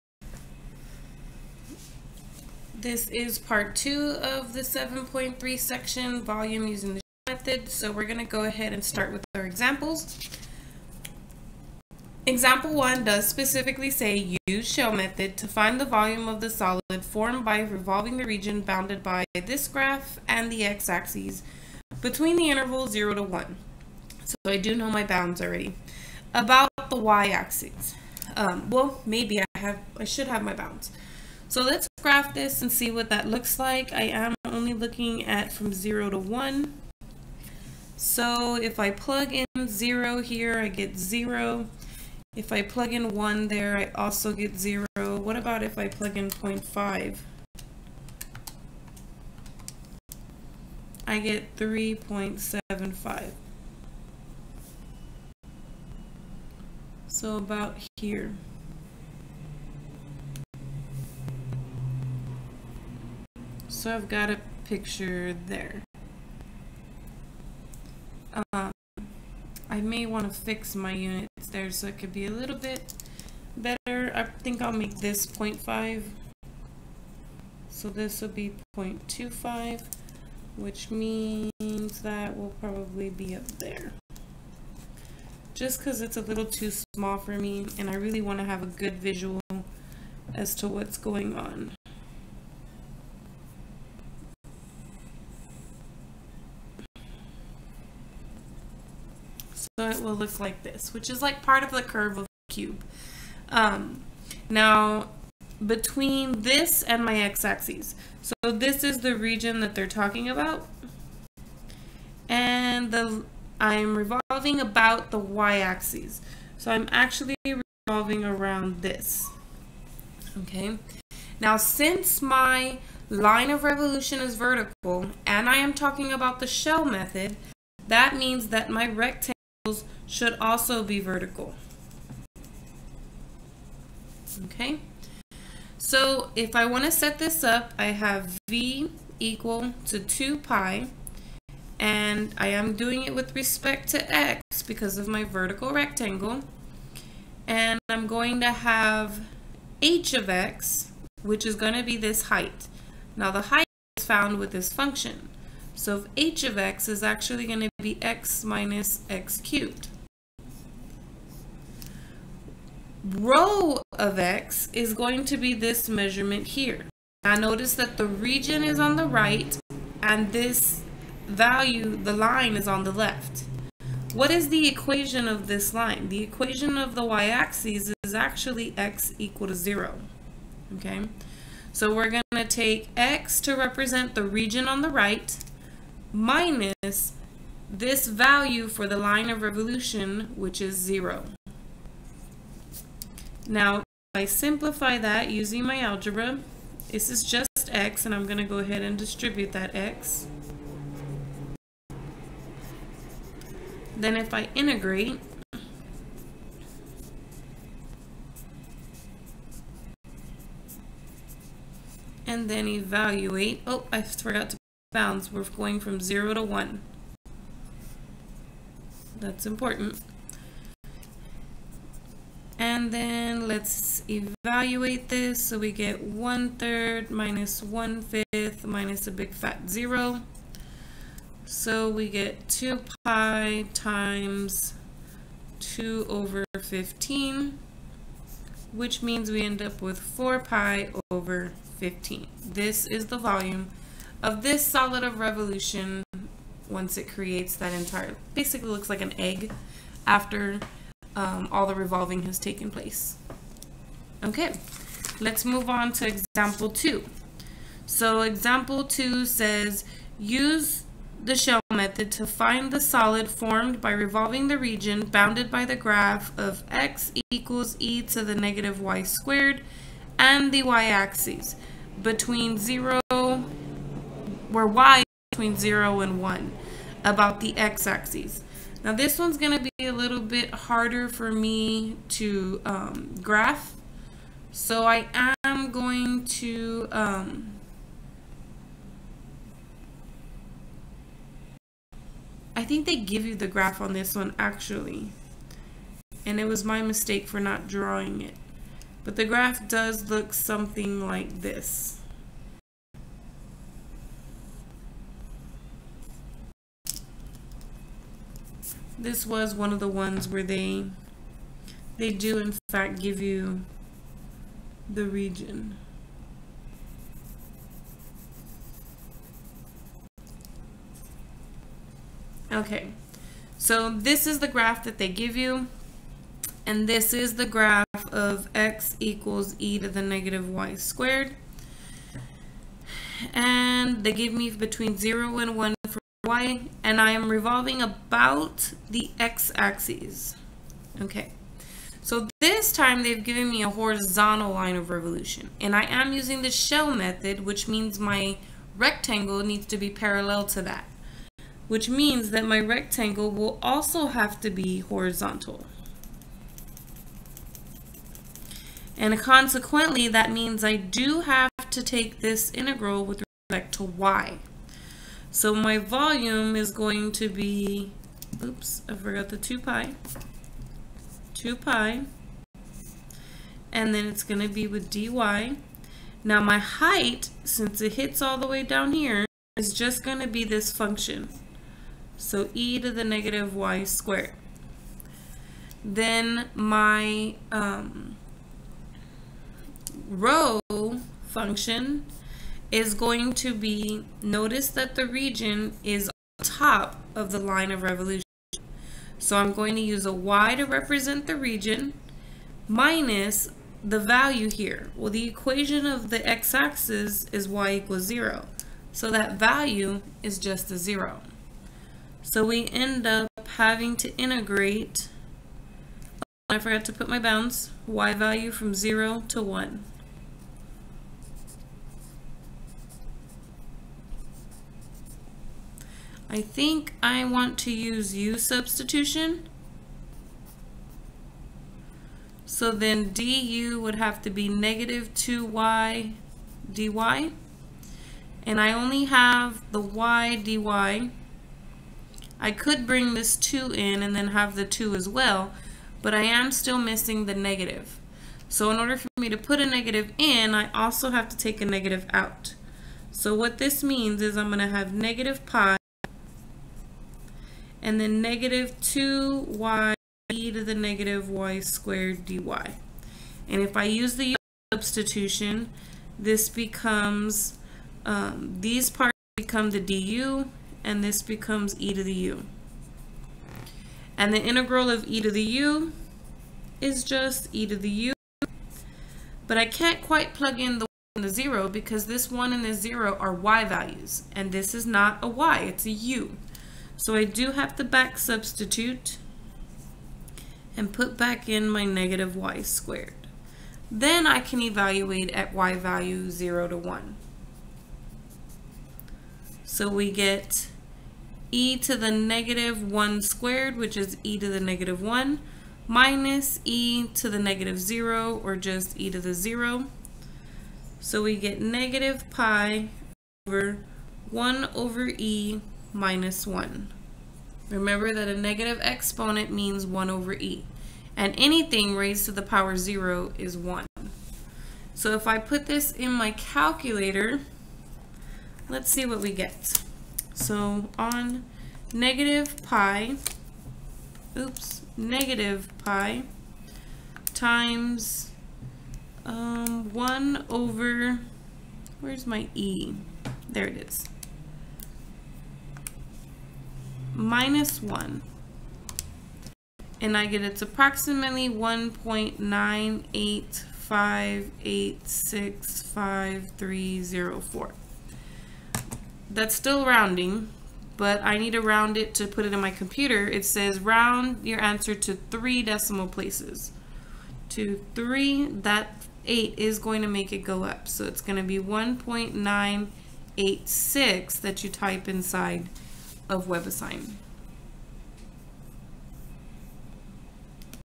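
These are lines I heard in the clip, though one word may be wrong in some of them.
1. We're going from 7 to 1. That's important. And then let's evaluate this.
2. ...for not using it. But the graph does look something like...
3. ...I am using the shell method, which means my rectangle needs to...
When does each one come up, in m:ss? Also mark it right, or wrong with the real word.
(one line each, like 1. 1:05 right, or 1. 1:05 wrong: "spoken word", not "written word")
1. 3:35 wrong: "0", not "7"
2. 4:57 wrong: "drawing", not "using"
3. 5:45 right.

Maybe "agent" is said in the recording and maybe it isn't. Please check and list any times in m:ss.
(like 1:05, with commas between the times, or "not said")
not said.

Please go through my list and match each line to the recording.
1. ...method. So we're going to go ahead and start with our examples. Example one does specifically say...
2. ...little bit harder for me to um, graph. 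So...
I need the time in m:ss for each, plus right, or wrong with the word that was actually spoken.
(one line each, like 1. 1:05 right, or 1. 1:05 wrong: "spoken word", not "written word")
1. 0:07 right
2. 4:39 right.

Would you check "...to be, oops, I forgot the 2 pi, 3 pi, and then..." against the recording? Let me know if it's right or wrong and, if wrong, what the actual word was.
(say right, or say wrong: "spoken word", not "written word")
wrong: "2", not "3".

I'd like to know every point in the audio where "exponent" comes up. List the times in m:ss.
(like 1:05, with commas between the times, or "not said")
8:38.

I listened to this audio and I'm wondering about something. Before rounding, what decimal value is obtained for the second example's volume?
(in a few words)
1.985865304.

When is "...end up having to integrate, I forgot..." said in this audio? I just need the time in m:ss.
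6:52.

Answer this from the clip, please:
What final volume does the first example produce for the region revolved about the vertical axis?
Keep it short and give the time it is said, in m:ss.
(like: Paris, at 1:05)
4 pi over 15, at 3:59.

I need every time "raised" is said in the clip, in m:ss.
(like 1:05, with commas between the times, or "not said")
8:41.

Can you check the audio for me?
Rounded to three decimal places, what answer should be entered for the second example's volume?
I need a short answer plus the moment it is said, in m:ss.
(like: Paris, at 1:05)
1.986, at 9:31.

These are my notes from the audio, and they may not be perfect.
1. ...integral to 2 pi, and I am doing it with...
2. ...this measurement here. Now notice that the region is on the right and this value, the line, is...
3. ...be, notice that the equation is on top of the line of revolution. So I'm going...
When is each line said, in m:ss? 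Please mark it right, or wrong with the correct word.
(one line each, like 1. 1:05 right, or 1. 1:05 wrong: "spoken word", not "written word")
1. 2:19 wrong: "equal", not "integral"
2. 2:45 right
3. 6:33 wrong: "region", not "equation".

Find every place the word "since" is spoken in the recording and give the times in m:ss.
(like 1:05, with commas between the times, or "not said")
2:01, 6:17.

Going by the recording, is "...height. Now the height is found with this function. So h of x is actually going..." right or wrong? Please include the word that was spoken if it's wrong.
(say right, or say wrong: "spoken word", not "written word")
right.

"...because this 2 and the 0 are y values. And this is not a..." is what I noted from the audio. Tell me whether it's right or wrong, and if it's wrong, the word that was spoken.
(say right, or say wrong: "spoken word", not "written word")
wrong: "1", not "2".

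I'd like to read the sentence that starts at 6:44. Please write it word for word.
Well, the equation of the x-axis is y equals 0.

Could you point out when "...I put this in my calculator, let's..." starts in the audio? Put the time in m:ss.
8:45.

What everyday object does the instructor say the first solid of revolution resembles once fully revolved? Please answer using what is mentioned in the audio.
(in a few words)
an egg.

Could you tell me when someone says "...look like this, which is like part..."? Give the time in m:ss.
1:40.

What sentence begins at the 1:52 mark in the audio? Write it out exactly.
And the I'm revolving about the y-axis.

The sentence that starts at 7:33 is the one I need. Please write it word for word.
So what this means is I'm going to have negative pi and then negative 2y e to the negative y squared dy.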